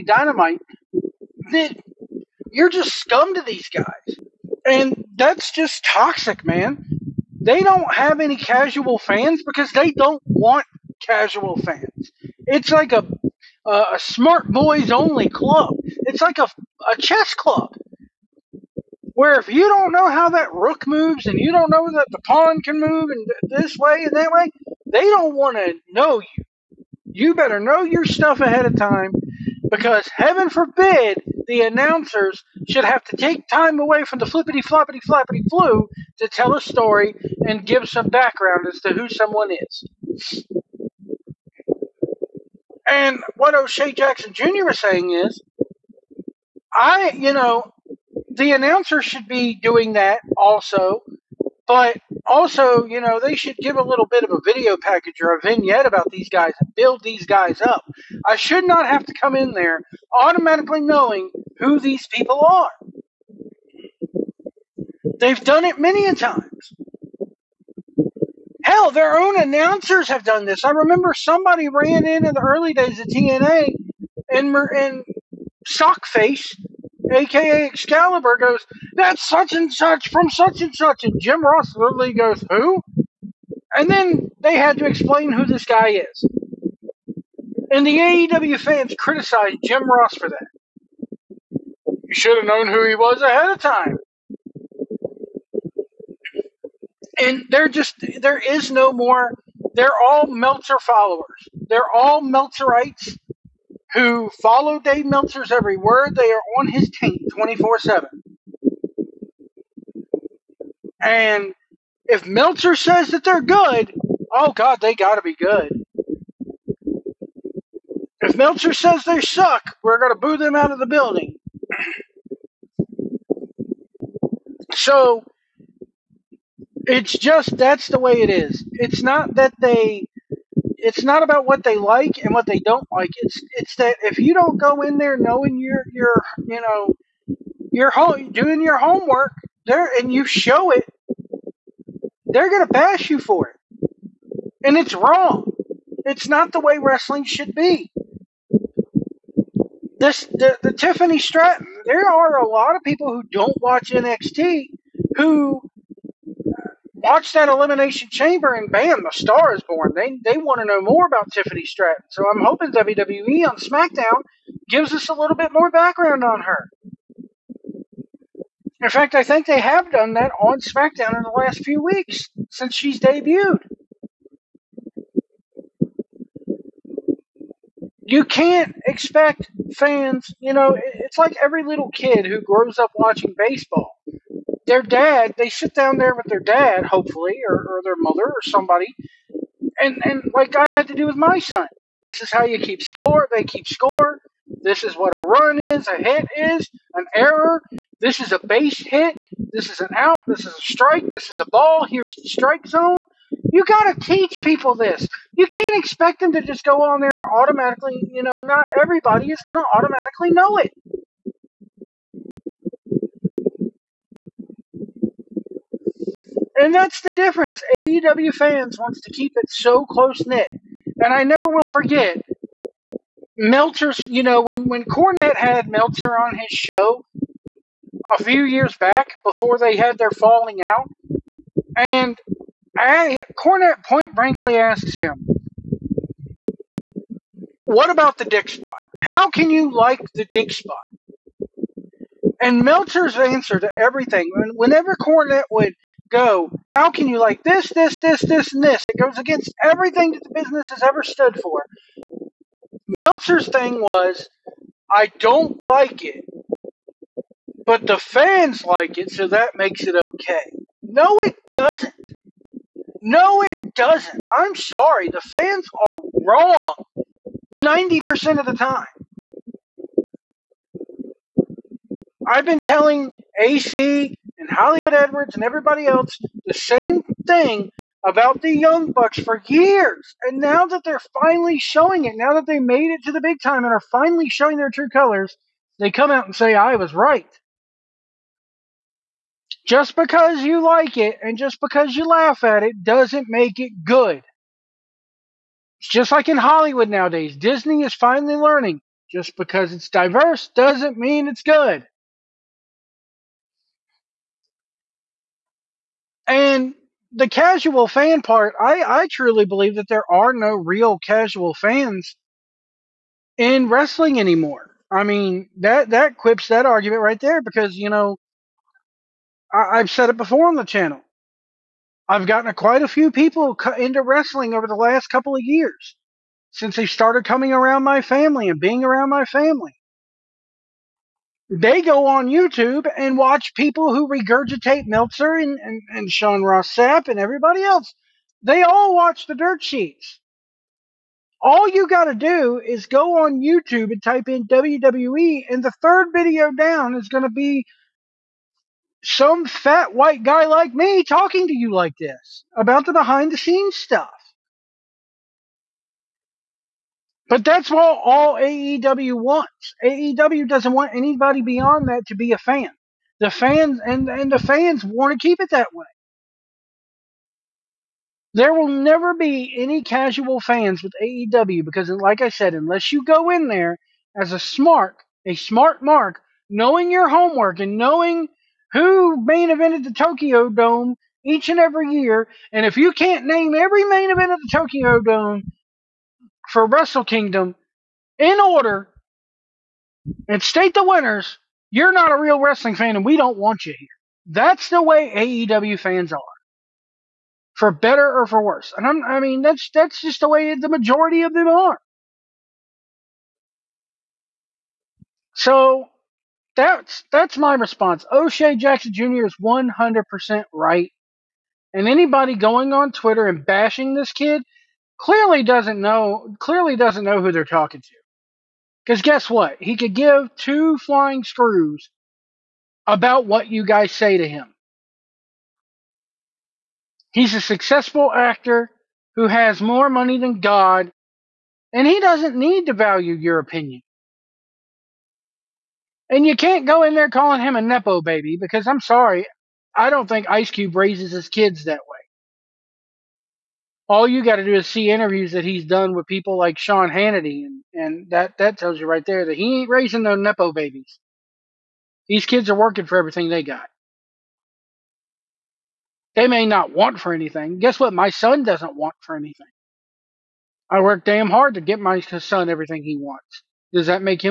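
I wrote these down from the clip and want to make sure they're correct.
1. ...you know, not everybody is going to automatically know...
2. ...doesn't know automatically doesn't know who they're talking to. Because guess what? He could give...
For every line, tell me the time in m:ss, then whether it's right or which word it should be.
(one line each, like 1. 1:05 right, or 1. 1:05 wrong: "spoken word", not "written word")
1. 3:28 right
2. 6:55 wrong: "clearly", not "automatically".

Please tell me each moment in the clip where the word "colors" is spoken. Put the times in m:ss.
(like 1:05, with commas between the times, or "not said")
4:44.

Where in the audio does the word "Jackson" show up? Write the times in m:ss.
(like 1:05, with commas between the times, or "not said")
0:43, 6:48.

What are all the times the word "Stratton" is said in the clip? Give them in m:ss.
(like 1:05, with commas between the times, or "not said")
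2:31, 2:41.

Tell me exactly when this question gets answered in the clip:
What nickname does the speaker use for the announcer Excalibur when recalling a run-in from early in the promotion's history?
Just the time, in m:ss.
1:15.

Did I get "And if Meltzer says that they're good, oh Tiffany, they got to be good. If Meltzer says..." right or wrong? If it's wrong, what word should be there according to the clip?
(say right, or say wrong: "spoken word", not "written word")
wrong: "God", not "Tiffany".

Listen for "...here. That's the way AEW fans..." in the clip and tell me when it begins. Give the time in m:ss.
6:33.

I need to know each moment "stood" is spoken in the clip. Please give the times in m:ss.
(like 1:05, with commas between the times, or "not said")
4:11.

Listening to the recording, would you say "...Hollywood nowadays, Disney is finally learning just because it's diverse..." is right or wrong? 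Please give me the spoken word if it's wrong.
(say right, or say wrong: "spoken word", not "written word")
right.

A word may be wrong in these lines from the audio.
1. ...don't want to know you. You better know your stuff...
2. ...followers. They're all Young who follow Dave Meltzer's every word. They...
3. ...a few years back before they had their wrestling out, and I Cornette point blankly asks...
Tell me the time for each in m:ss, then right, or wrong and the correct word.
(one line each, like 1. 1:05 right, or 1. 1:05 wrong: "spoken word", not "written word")
1. 0:25 right
2. 1:40 wrong: "Meltzerites", not "Young"
3. 3:48 wrong: "falling", not "wrestling".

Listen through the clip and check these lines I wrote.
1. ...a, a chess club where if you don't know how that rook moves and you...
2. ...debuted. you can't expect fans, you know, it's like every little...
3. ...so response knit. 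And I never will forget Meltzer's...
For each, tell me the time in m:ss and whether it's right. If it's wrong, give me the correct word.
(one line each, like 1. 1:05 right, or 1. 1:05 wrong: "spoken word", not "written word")
1. 0:16 right
2. 2:52 right
3. 3:39 wrong: "close", not "response".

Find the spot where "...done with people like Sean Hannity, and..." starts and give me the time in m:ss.
7:25.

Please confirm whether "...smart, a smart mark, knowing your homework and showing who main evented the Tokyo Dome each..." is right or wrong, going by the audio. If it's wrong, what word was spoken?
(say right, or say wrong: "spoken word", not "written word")
wrong: "knowing", not "showing".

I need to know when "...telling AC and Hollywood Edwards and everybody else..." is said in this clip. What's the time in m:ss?
4:32.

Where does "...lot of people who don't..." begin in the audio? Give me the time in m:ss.
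2:32.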